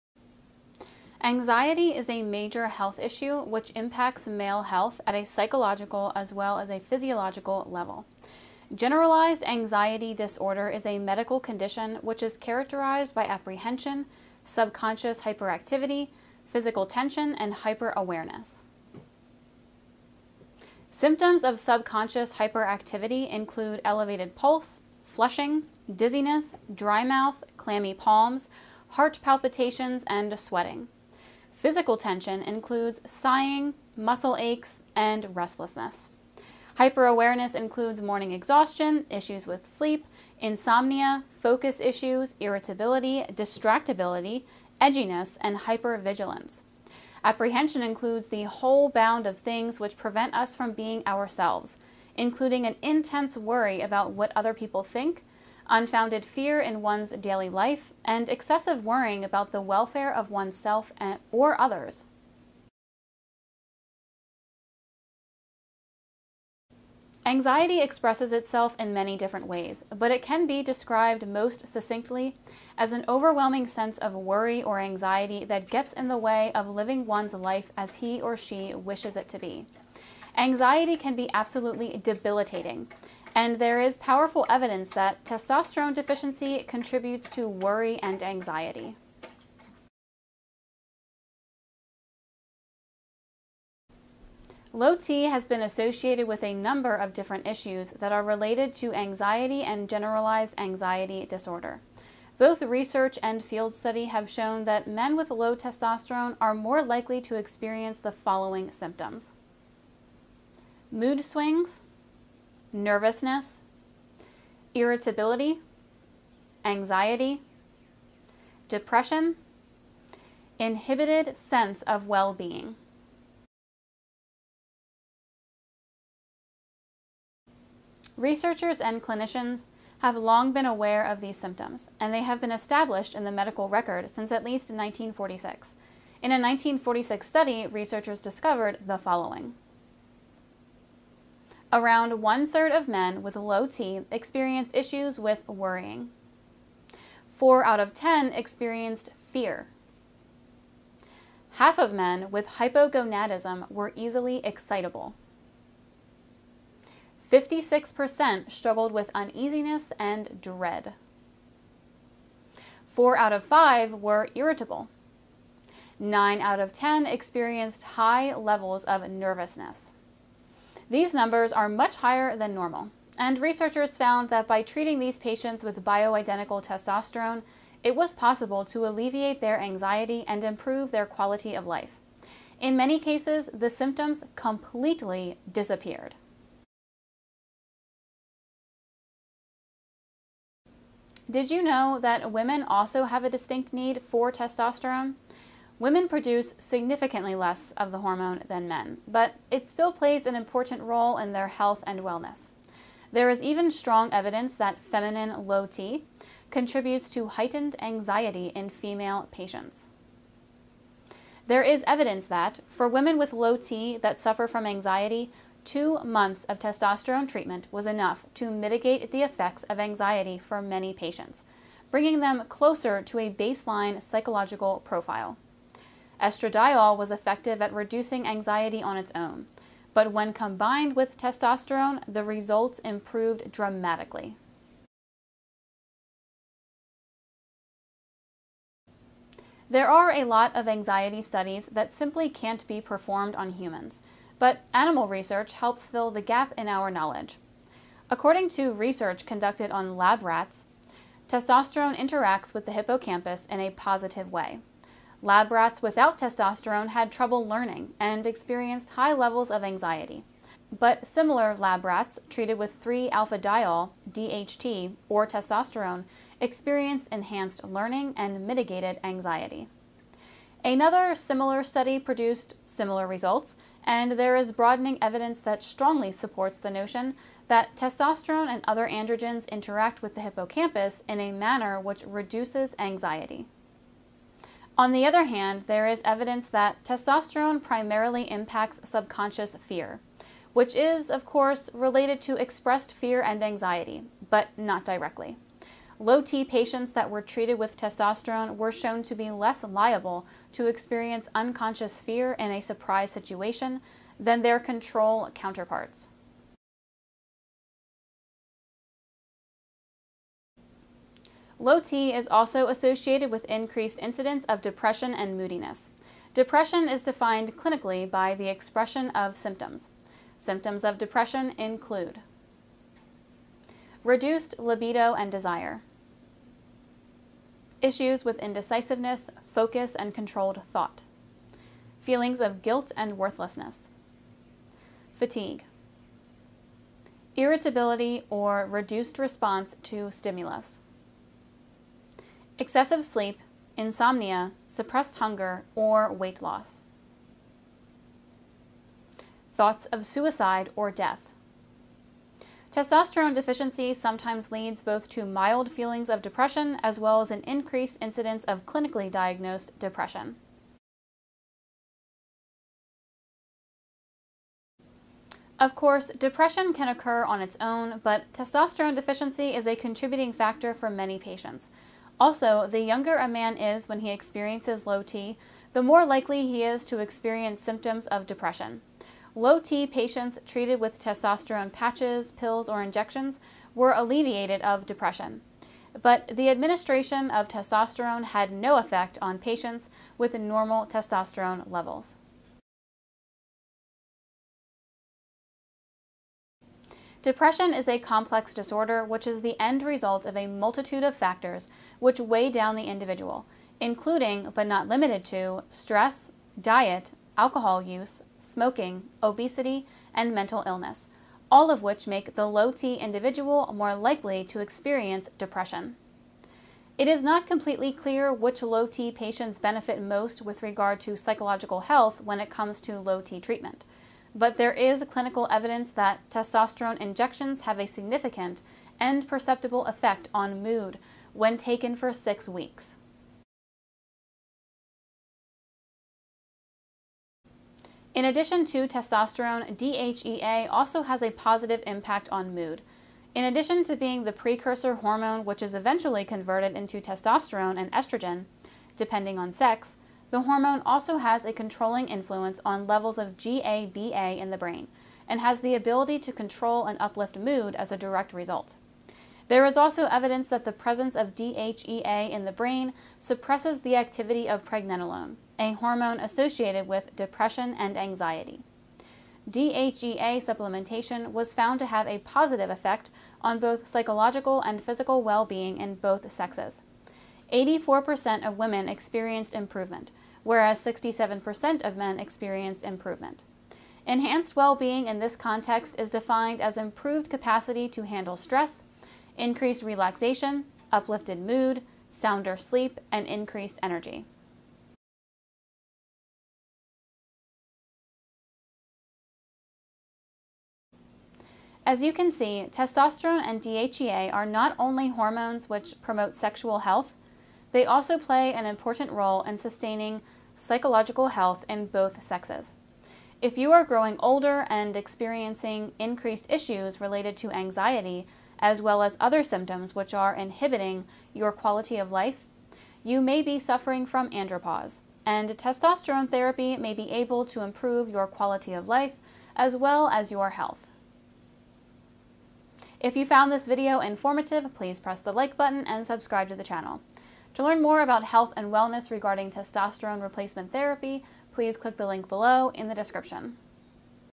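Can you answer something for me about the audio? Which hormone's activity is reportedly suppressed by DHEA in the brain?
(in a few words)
Pregnenolone.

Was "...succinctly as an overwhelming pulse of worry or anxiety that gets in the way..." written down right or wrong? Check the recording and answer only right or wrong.
wrong.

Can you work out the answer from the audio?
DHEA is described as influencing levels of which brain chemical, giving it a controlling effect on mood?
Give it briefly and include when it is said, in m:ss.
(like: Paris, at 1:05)
GABA, at 7:33.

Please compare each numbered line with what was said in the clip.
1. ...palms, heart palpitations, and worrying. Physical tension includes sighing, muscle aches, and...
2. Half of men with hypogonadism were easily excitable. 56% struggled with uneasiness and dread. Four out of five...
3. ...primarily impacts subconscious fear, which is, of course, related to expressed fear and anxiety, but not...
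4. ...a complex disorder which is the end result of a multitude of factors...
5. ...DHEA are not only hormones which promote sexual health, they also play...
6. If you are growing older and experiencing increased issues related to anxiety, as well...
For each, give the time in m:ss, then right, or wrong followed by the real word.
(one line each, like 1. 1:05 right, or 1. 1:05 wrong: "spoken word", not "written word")
1. 0:27 wrong: "sweating", not "worrying"
2. 2:31 right
3. 4:47 right
4. 6:37 right
5. 8:23 right
6. 8:33 right.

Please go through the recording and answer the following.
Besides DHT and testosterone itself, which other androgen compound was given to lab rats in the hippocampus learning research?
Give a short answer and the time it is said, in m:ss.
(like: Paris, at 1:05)
3-alpha-diol, at 4:22.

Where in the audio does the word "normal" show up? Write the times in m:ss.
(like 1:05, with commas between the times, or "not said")
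2:52, 6:30.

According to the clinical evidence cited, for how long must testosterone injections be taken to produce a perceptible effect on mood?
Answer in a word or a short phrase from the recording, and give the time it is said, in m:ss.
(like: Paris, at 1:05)
6 weeks, at 7:12.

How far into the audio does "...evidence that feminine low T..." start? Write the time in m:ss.
3:24.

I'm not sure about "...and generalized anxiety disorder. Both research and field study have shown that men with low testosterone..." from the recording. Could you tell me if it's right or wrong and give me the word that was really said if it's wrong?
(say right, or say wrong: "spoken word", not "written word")
right.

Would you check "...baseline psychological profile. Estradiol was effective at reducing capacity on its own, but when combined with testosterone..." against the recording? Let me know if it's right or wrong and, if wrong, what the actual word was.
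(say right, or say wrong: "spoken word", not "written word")
wrong: "anxiety", not "capacity".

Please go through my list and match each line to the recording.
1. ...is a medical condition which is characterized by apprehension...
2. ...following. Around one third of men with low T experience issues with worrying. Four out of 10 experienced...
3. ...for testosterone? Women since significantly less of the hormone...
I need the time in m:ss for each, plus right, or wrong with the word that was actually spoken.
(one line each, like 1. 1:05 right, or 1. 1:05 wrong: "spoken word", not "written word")
1. 0:10 right
2. 2:18 right
3. 3:14 wrong: "produce", not "since".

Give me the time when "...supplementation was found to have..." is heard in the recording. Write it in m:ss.
7:50.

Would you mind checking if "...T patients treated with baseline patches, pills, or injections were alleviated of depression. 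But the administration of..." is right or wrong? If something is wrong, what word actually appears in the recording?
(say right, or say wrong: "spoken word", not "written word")
wrong: "testosterone", not "baseline".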